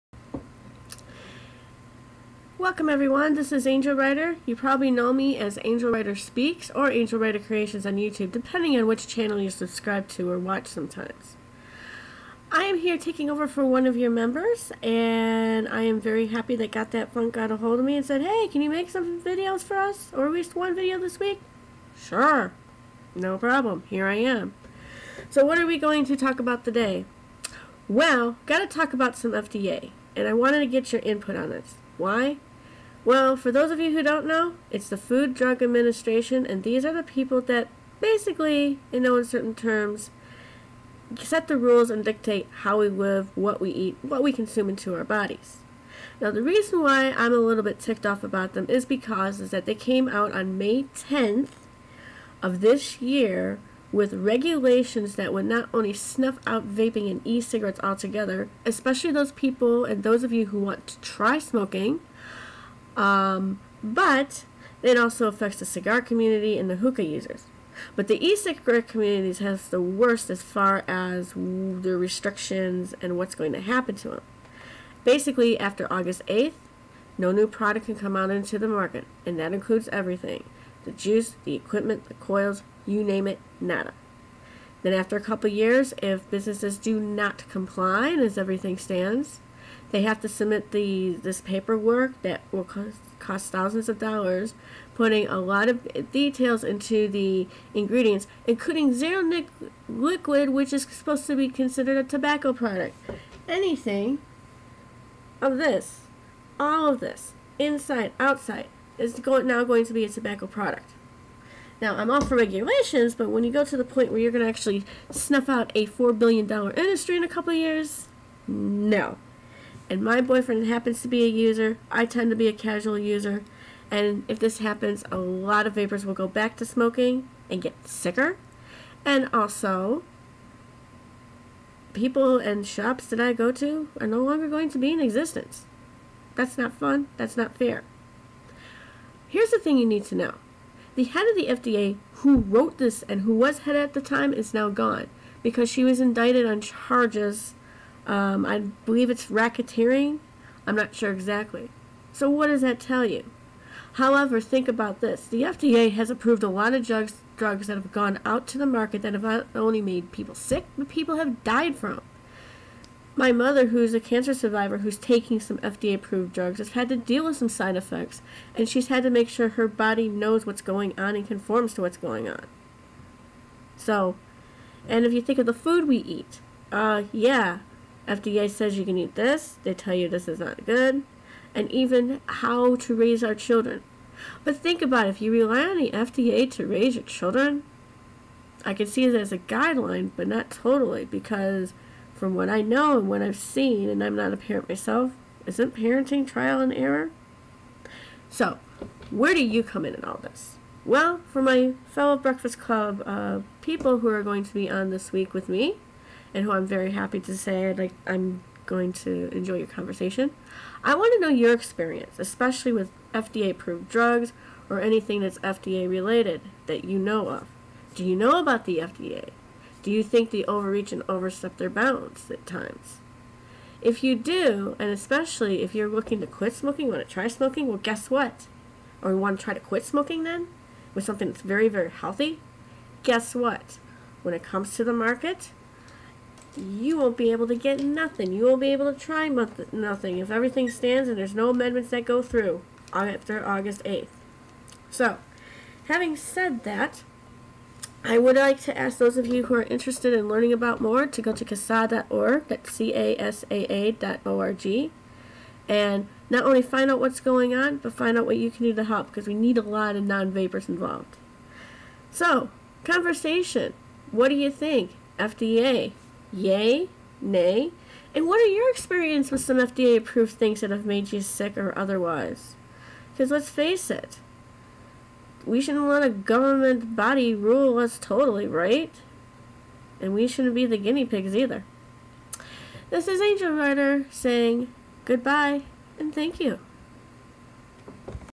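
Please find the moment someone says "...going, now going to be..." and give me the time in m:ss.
1:49.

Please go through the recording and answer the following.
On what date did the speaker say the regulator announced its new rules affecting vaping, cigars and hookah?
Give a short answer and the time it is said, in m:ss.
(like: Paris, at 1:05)
May 10th, at 0:50.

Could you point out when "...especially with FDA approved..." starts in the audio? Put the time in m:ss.
3:32.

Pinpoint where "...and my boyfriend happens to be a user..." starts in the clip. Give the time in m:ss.
1:59.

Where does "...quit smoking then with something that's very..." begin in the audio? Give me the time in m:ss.
3:49.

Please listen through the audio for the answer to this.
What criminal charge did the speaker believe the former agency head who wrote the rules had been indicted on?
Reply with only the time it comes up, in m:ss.
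2:29.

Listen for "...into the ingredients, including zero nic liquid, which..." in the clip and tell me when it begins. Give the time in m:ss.
1:36.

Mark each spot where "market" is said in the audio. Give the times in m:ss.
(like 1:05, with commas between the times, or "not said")
1:18, 2:38, 3:54.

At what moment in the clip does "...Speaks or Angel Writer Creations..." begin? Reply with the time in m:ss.
0:06.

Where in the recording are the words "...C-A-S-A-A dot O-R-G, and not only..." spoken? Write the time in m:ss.
4:12.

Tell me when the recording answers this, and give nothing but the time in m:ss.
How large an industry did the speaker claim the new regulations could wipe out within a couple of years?
1:55.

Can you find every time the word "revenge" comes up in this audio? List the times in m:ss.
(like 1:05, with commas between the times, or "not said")
not said.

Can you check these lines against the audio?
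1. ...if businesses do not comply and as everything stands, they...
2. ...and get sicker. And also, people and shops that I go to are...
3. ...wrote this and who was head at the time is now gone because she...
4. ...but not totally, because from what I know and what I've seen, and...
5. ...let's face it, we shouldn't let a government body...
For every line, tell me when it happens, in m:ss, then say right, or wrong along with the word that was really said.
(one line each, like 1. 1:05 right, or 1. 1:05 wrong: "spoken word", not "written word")
1. 1:26 right
2. 2:07 right
3. 2:22 right
4. 3:10 right
5. 4:33 right.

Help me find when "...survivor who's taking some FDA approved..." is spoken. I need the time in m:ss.
2:44.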